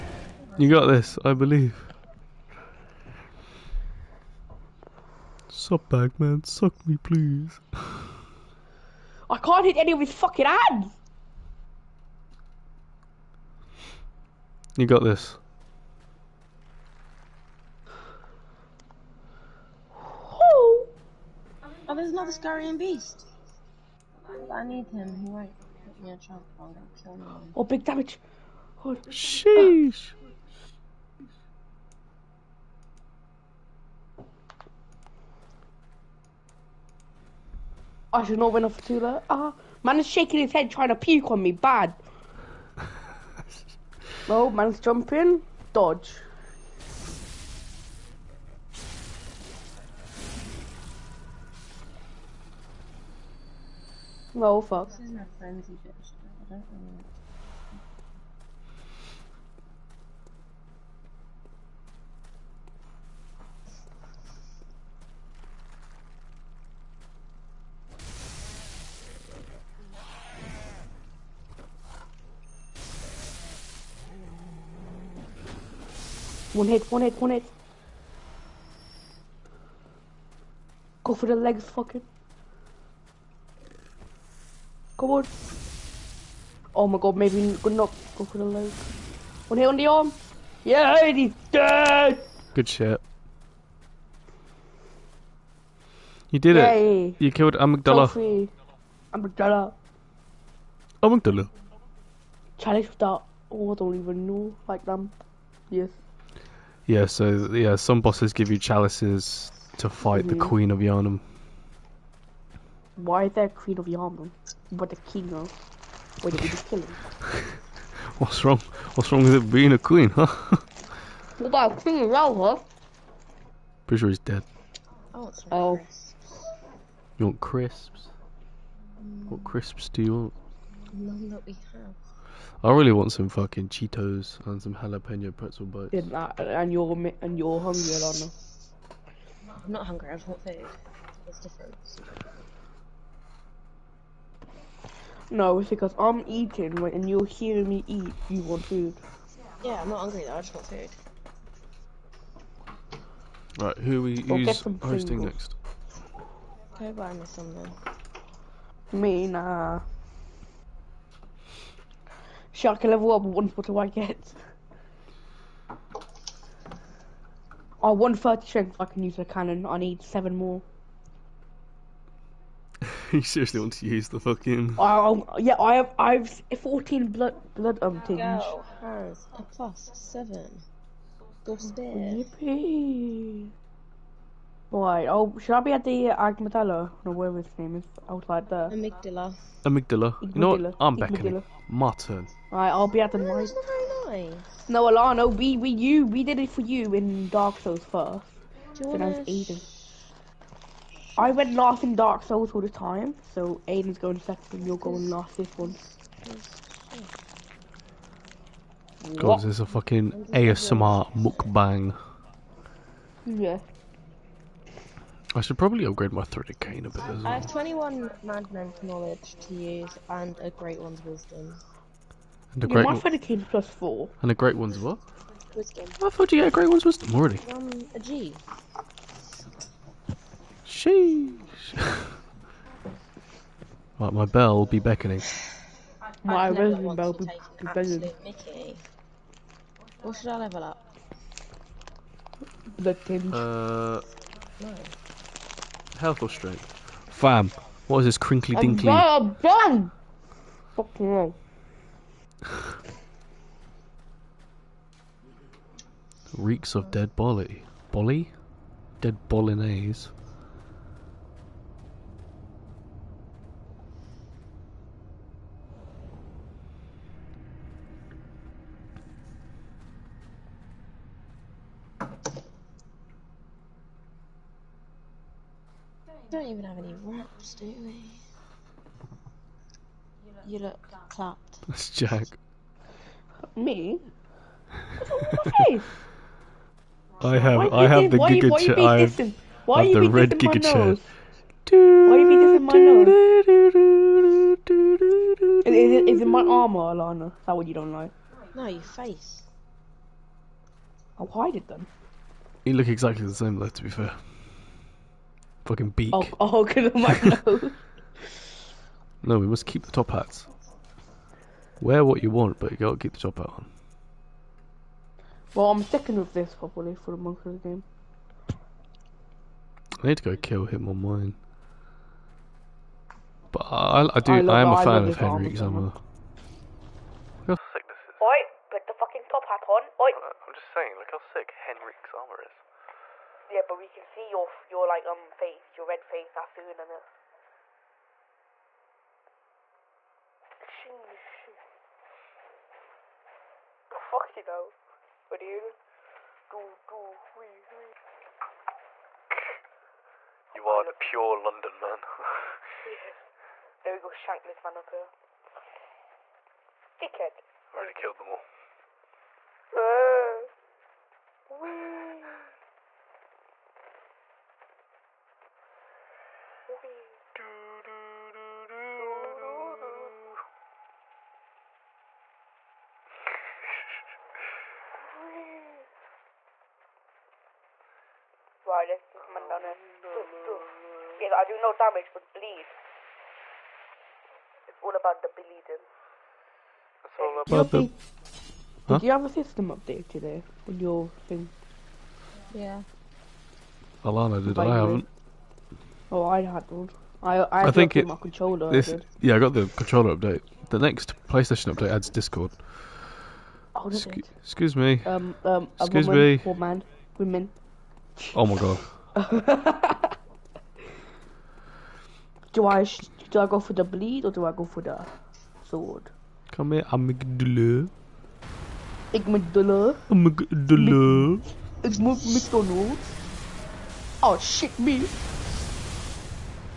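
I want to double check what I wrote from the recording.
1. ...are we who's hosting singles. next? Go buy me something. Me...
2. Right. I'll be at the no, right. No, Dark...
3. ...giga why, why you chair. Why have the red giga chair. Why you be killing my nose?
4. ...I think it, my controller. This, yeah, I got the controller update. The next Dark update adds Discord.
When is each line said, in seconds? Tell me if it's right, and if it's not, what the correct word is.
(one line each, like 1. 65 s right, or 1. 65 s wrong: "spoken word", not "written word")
1. 153 s right
2. 192 s wrong: "Alano", not "Dark"
3. 288 s wrong: "dissing", not "killing"
4. 397 s wrong: "PlayStation", not "Dark".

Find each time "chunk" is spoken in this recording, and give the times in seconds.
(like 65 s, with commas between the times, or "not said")
26 s.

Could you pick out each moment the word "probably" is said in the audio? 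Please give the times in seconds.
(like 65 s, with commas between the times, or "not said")
215 s, 316 s.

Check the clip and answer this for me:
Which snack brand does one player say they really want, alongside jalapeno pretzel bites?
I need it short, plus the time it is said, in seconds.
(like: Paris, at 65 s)
Cheetos, at 133 s.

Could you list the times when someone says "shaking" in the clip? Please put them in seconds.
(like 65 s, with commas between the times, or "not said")
40 s.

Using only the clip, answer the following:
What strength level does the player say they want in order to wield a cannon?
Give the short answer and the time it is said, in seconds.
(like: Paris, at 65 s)
30, at 168 s.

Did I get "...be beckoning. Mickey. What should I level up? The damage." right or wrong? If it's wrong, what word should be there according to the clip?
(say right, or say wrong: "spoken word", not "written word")
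wrong: "tinge", not "damage".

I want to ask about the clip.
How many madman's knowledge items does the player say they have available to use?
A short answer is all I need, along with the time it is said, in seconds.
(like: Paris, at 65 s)
21, at 217 s.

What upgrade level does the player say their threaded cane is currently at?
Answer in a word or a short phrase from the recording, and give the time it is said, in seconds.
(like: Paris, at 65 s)
+4, at 223 s.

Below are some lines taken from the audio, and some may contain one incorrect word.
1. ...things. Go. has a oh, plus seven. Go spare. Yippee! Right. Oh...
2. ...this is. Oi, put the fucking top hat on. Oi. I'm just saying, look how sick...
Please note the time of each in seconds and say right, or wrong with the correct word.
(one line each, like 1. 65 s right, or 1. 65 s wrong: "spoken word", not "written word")
1. 178 s right
2. 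327 s right.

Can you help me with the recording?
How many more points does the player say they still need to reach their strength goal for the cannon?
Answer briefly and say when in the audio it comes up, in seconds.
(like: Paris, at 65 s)
7, at 170 s.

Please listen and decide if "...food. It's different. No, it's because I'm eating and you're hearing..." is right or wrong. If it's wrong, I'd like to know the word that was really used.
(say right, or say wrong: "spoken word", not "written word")
right.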